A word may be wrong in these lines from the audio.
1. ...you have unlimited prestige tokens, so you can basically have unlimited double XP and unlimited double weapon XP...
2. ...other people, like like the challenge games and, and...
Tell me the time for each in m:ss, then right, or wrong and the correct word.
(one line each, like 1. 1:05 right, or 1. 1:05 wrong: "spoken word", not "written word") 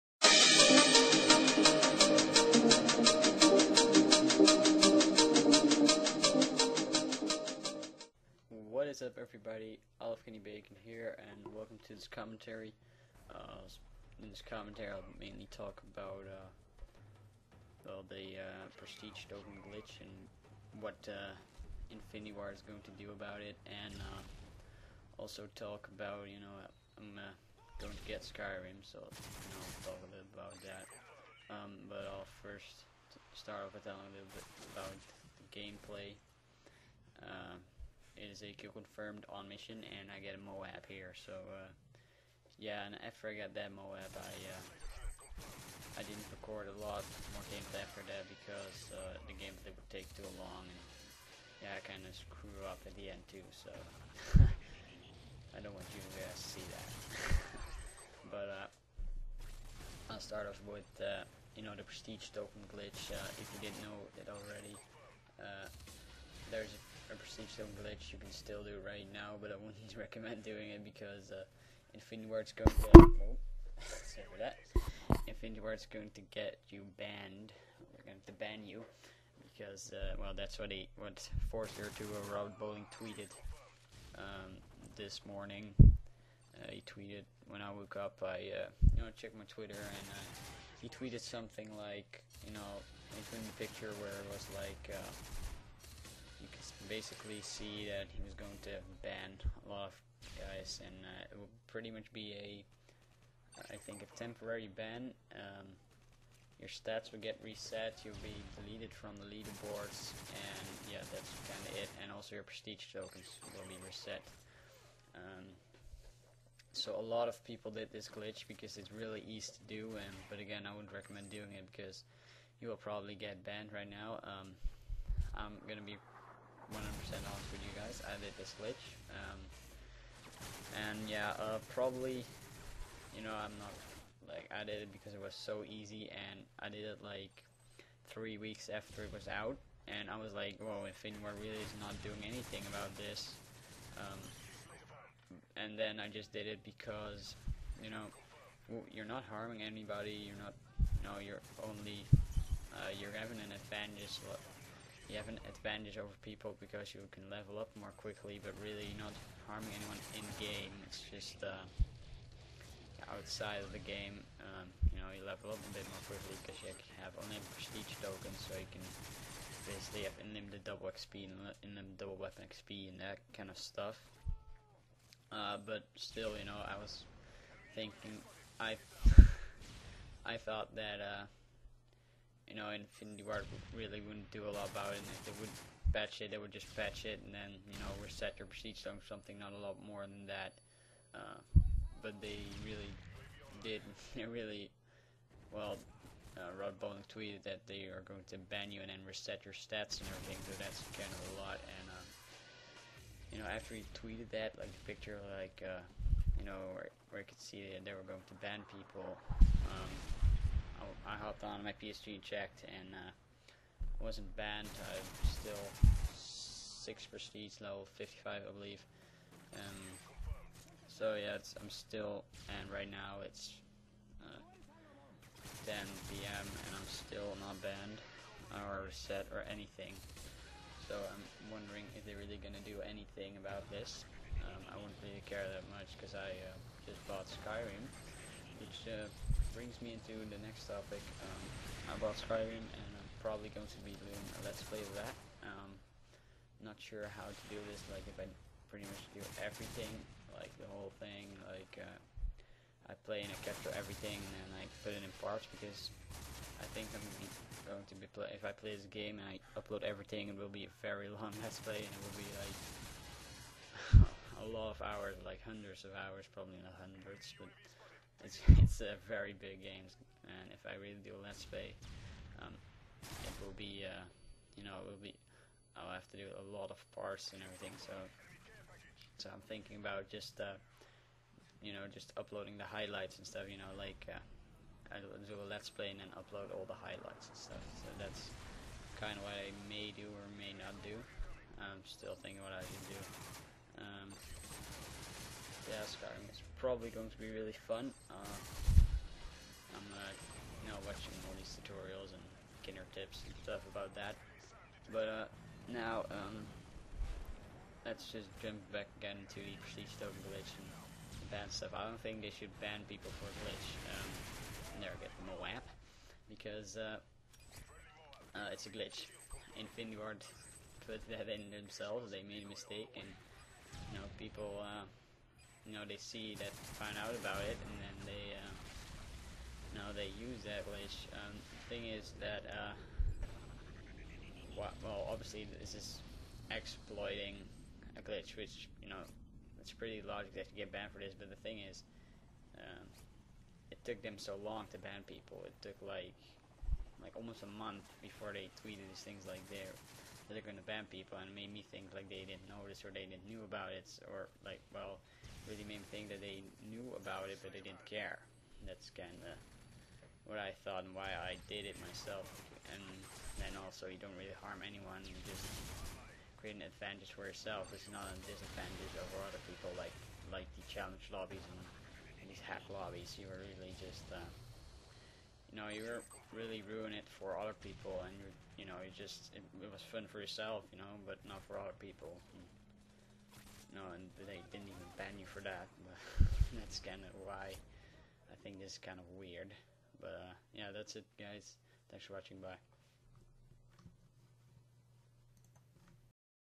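1. 2:46 right
2. 6:09 wrong: "lobbies", not "games".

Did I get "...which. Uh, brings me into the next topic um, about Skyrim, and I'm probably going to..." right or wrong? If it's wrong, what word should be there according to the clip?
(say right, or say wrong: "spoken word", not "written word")
right.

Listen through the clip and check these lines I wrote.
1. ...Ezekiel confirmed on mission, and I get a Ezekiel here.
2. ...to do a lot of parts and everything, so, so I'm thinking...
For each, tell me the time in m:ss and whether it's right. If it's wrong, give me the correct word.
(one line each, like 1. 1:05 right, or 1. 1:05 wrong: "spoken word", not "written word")
1. 0:38 wrong: "MOAB", not "Ezekiel"
2. 4:36 right.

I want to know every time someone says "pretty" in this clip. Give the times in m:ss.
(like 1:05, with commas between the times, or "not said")
1:41, 4:08, 5:39.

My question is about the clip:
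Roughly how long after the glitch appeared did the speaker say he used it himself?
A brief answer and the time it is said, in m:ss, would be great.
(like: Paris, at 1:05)
3 weeks, at 2:18.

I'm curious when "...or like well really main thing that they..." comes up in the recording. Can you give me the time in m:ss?
5:54.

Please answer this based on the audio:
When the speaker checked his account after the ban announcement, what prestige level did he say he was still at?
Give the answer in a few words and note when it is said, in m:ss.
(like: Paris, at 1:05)
6, at 3:36.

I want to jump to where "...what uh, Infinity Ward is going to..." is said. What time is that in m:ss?
0:20.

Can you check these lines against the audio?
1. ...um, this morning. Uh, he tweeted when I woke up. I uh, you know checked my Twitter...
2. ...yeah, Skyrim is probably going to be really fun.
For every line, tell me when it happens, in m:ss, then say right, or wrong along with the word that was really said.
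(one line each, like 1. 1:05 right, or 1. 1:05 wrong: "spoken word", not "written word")
1. 1:24 right
2. 4:55 right.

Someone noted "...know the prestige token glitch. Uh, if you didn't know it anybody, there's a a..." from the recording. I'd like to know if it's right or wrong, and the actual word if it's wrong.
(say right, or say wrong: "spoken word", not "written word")
wrong: "already", not "anybody".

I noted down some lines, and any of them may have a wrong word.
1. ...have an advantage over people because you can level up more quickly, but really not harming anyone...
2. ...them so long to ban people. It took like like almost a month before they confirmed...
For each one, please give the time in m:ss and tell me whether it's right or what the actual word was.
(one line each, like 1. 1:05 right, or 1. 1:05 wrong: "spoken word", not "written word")
1. 2:35 right
2. 5:44 wrong: "tweeted", not "confirmed".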